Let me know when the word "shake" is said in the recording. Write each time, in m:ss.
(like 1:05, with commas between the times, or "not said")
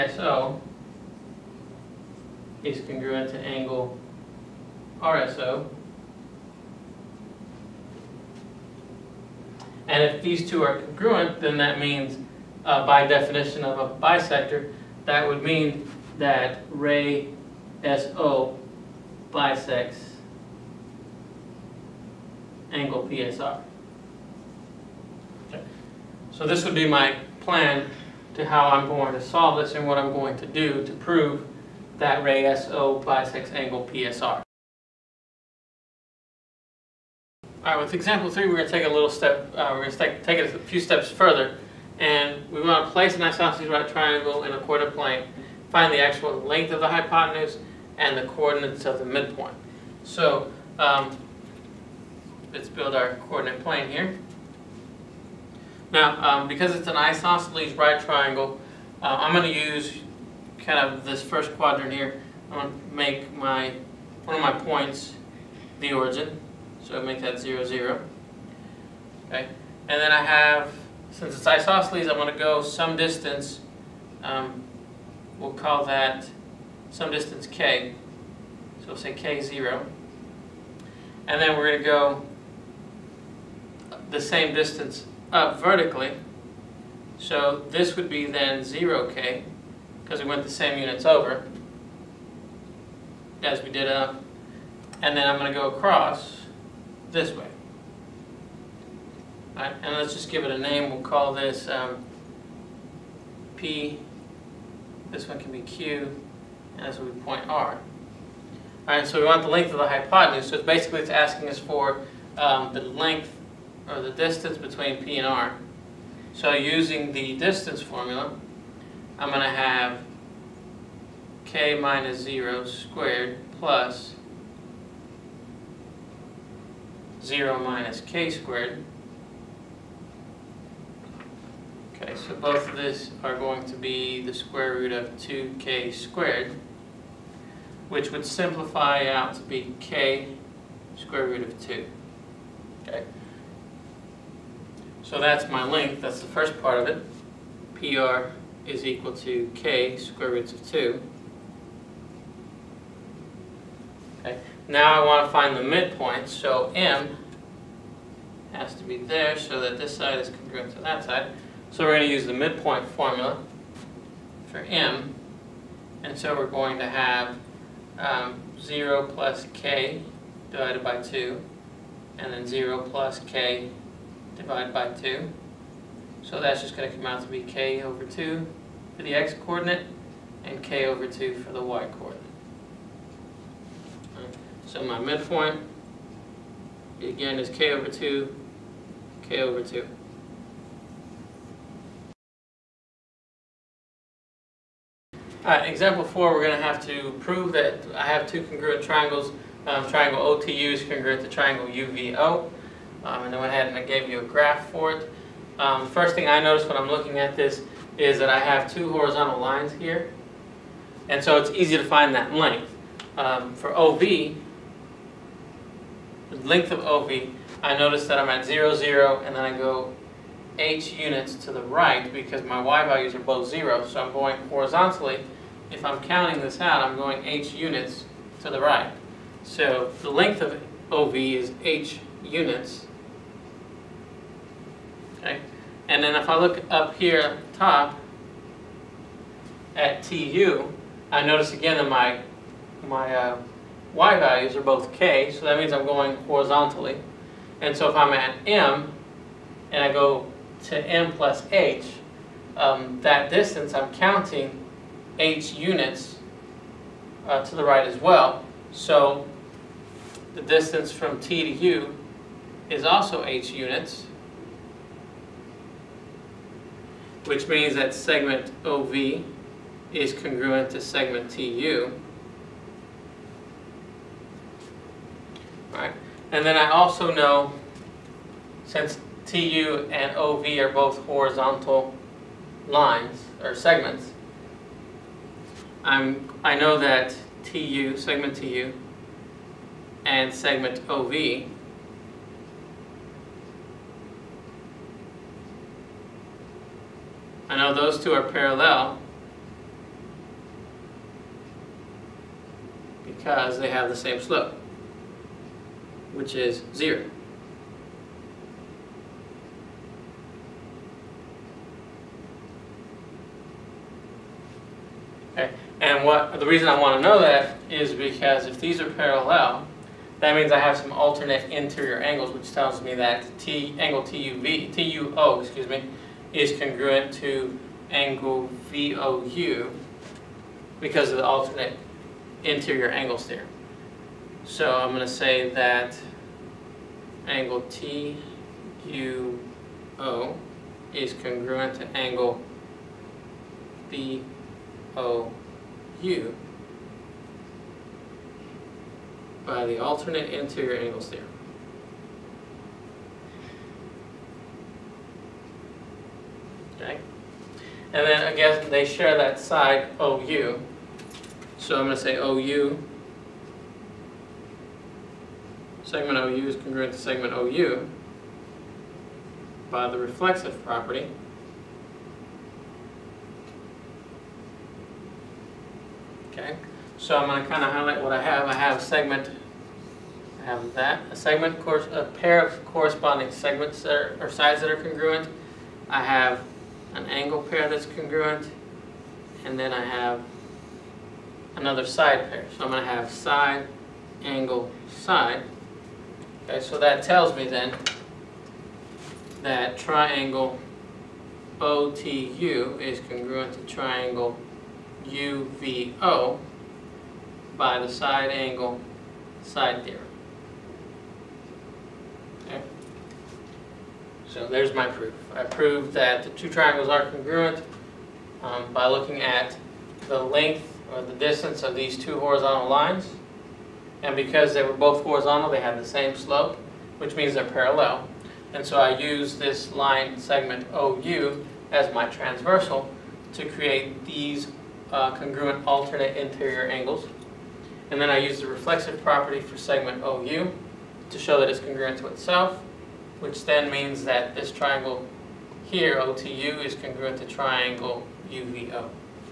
not said.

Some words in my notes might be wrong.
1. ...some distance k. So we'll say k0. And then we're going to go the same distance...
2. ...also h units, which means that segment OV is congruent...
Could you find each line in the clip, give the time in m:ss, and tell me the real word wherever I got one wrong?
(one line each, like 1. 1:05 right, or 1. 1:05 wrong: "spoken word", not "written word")
1. 1:16 right
2. 4:22 right.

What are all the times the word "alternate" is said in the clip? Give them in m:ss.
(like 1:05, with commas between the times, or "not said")
5:20, 5:31, 5:49, 7:15.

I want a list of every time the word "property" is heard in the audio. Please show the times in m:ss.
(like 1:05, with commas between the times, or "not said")
6:10, 7:19.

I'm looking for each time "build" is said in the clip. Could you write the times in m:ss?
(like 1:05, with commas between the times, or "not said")
0:52.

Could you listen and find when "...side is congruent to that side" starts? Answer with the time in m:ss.
2:39.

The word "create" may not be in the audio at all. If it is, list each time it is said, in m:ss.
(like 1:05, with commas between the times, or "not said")
7:13.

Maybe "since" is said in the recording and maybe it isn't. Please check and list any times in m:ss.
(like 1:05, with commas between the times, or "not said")
1:11, 4:38.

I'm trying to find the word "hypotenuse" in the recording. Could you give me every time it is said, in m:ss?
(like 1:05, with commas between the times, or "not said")
0:46, 1:49.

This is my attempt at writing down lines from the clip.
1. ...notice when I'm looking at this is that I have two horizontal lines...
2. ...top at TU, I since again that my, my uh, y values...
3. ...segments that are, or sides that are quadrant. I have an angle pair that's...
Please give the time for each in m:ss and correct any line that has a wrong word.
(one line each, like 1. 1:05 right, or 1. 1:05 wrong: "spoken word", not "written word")
1. 3:26 right
2. 3:57 wrong: "notice", not "since"
3. 6:23 wrong: "congruent", not "quadrant".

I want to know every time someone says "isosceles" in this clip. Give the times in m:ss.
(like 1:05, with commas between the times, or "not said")
0:43, 0:56, 1:11.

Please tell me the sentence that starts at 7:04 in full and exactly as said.
And because they were both horizontal, they had the same slope, which means they're parallel.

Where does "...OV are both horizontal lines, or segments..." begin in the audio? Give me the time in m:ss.
4:40.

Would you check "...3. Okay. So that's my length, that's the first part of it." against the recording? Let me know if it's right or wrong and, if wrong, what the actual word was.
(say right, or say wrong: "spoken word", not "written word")
wrong: "2", not "3".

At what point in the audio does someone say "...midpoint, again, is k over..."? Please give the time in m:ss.
3:04.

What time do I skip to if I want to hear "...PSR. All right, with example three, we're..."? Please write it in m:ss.
0:33.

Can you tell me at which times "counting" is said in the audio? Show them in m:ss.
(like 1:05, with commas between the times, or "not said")
3:46, 4:13.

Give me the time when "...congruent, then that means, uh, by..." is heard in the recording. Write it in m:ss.
0:10.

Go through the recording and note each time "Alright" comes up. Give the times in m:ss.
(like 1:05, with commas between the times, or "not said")
3:15.